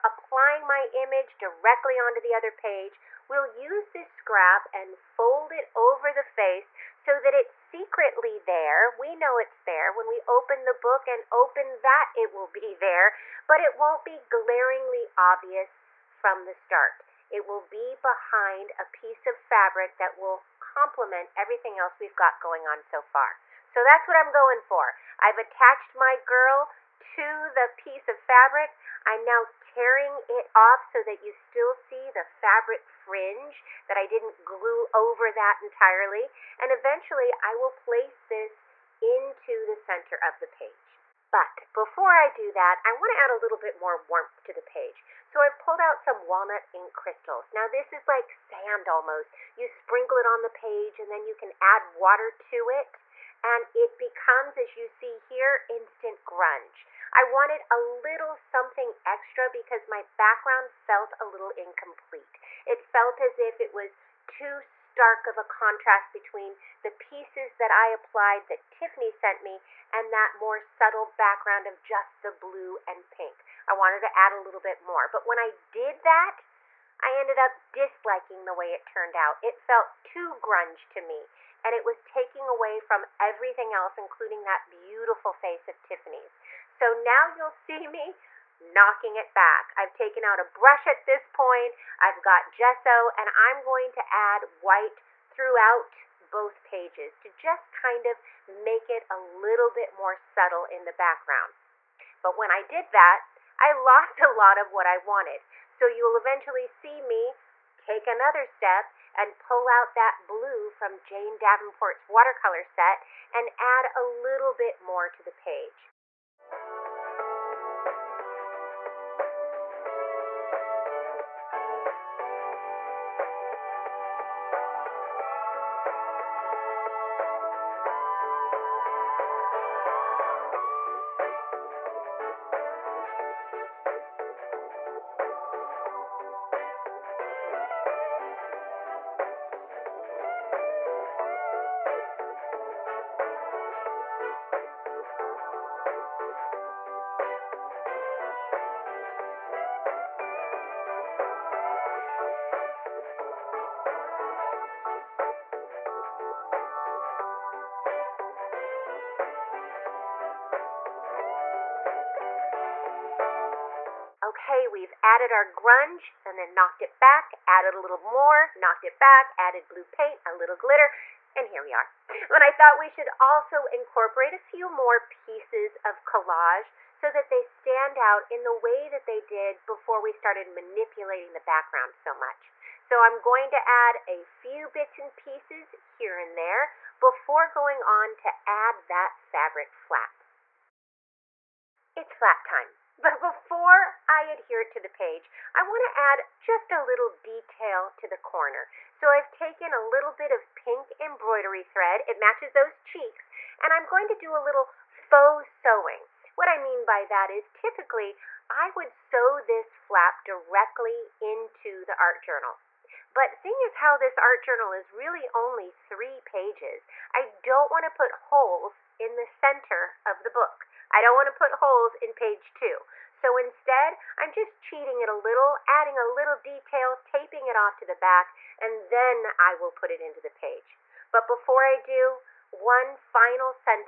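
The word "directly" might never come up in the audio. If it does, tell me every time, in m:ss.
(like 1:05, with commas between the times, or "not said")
0:01, 3:30.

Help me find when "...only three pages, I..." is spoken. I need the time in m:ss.
3:35.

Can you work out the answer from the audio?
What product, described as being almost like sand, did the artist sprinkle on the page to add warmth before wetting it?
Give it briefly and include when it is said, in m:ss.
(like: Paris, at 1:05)
Walnut ink crystals, at 0:46.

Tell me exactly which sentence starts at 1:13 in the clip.
I wanted to add a little bit more.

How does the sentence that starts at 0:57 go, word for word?
I wanted a little something extra because my background felt a little incomplete.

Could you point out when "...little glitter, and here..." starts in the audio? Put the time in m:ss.
2:50.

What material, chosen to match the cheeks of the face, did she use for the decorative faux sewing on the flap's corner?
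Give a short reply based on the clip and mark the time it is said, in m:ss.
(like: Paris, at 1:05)
Pink embroidery thread, at 3:20.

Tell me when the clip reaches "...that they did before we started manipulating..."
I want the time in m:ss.
2:58.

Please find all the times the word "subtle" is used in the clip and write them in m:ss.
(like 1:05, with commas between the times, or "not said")
1:10, 1:40.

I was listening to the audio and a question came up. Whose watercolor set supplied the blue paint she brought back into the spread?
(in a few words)
Jane Davenport.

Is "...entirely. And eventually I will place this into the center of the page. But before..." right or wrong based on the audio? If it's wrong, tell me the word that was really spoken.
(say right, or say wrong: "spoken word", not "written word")
right.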